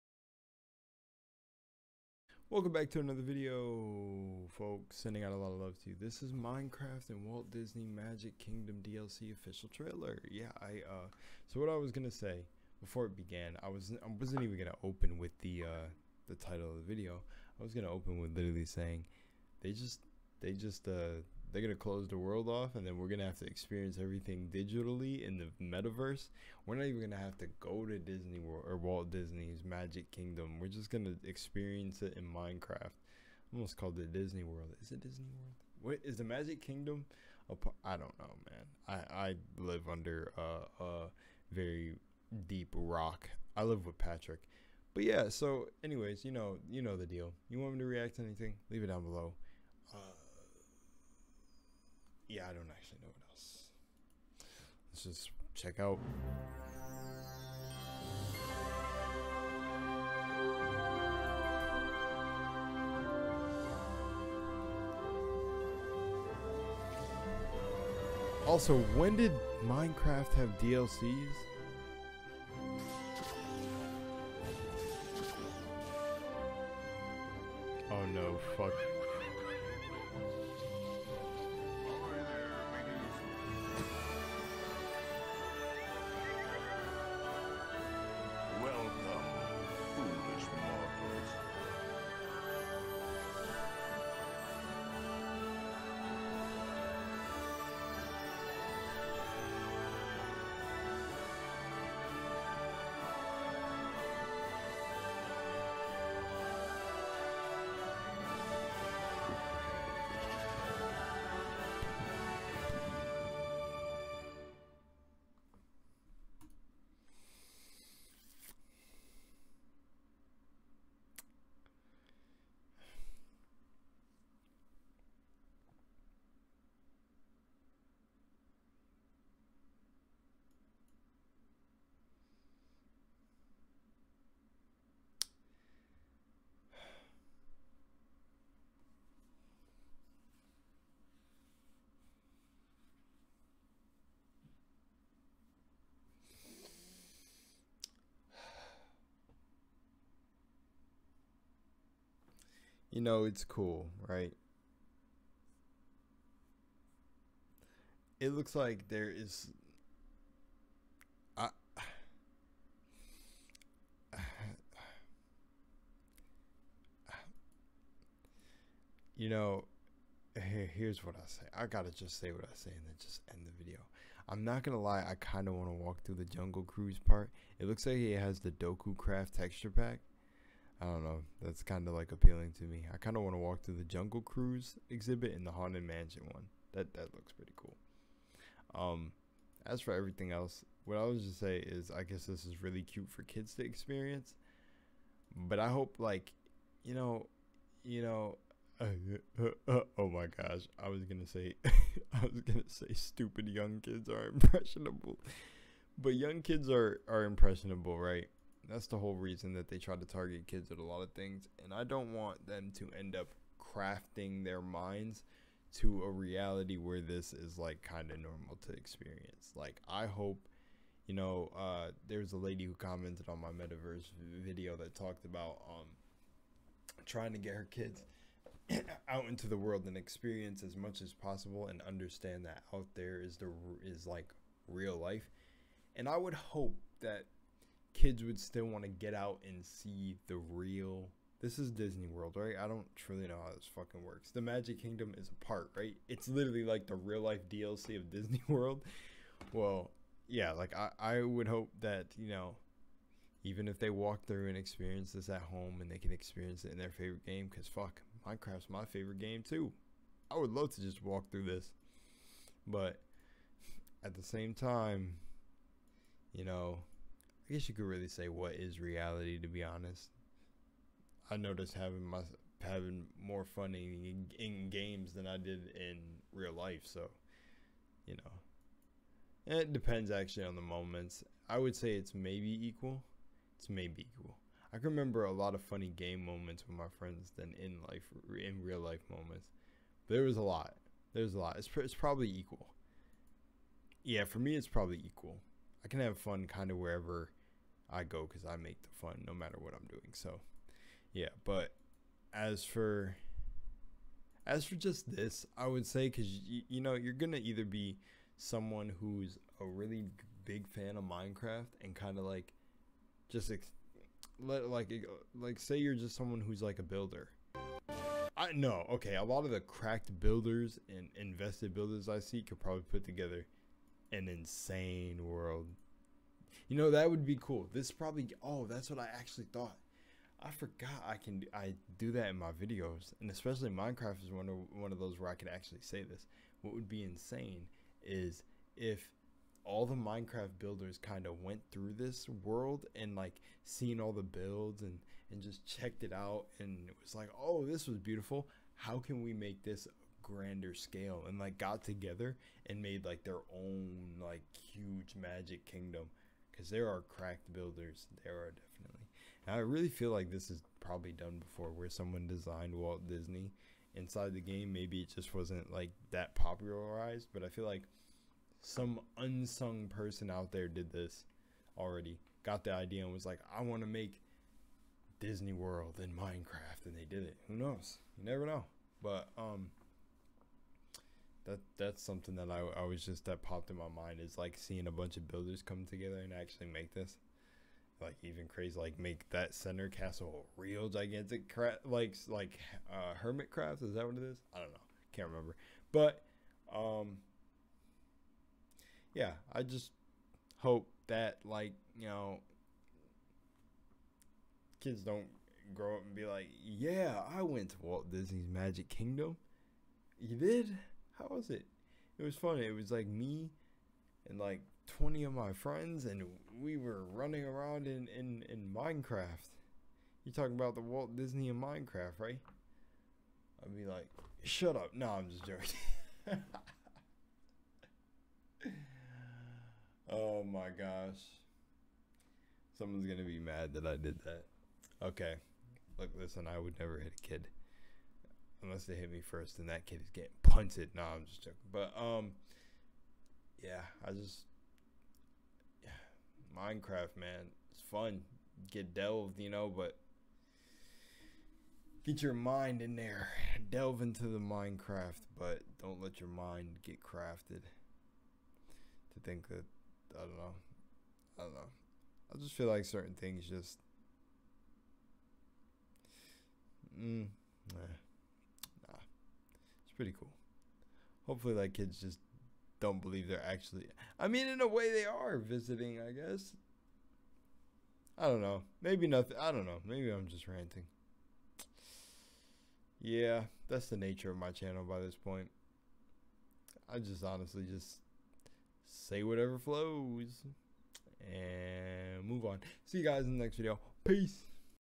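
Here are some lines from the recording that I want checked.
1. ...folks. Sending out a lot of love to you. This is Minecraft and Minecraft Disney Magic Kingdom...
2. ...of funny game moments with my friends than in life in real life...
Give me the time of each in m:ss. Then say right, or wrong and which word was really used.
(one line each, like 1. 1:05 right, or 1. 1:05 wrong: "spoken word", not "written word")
1. 0:04 wrong: "Walt", not "Minecraft"
2. 4:45 right.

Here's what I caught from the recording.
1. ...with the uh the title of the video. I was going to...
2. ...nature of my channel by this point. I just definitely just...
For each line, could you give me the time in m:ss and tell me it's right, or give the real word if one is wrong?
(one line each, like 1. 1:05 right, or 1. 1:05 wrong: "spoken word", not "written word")
1. 0:15 right
2. 8:03 wrong: "honestly", not "definitely".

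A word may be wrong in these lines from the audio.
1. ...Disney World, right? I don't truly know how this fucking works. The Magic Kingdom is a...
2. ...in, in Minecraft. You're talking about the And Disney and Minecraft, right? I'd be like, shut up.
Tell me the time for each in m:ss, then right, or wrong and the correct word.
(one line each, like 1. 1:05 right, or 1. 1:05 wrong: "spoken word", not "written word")
1. 4:01 right
2. 6:58 wrong: "Walt", not "And".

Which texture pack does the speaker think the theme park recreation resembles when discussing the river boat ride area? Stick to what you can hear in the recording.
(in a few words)
Dokucraft.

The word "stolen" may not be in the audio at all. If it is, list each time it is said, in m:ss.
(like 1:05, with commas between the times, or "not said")
not said.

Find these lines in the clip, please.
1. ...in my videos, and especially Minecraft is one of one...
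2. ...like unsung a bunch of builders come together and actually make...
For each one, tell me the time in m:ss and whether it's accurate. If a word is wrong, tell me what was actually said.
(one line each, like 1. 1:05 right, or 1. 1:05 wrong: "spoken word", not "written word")
1. 5:32 right
2. 6:24 wrong: "seeing", not "unsung".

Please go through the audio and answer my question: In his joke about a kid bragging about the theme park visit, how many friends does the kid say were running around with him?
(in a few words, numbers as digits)
20.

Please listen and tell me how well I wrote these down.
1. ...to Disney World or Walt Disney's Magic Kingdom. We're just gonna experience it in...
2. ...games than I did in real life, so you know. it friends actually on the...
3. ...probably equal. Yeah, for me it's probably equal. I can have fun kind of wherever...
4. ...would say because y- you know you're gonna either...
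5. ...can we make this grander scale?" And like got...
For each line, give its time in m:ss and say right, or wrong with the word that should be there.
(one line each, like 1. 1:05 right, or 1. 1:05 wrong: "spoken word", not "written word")
1. 0:27 right
2. 4:34 wrong: "depends", not "friends"
3. 4:51 right
4. 5:05 right
5. 5:48 right.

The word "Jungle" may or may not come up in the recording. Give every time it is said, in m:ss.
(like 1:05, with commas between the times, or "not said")
2:56, 3:03.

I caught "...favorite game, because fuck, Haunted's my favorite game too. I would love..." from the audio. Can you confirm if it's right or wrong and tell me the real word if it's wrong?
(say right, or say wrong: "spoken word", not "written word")
wrong: "Minecraft", not "Haunted".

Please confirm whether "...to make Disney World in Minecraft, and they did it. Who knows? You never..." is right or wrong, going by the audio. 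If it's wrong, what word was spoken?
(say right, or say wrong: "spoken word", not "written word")
right.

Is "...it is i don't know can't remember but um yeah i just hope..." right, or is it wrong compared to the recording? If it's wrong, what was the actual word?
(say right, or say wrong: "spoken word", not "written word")
right.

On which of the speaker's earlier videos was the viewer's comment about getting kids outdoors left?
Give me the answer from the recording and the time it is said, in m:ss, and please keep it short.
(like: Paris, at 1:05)
metaverse video, at 3:43.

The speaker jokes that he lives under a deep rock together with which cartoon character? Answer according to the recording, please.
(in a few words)
Patrick.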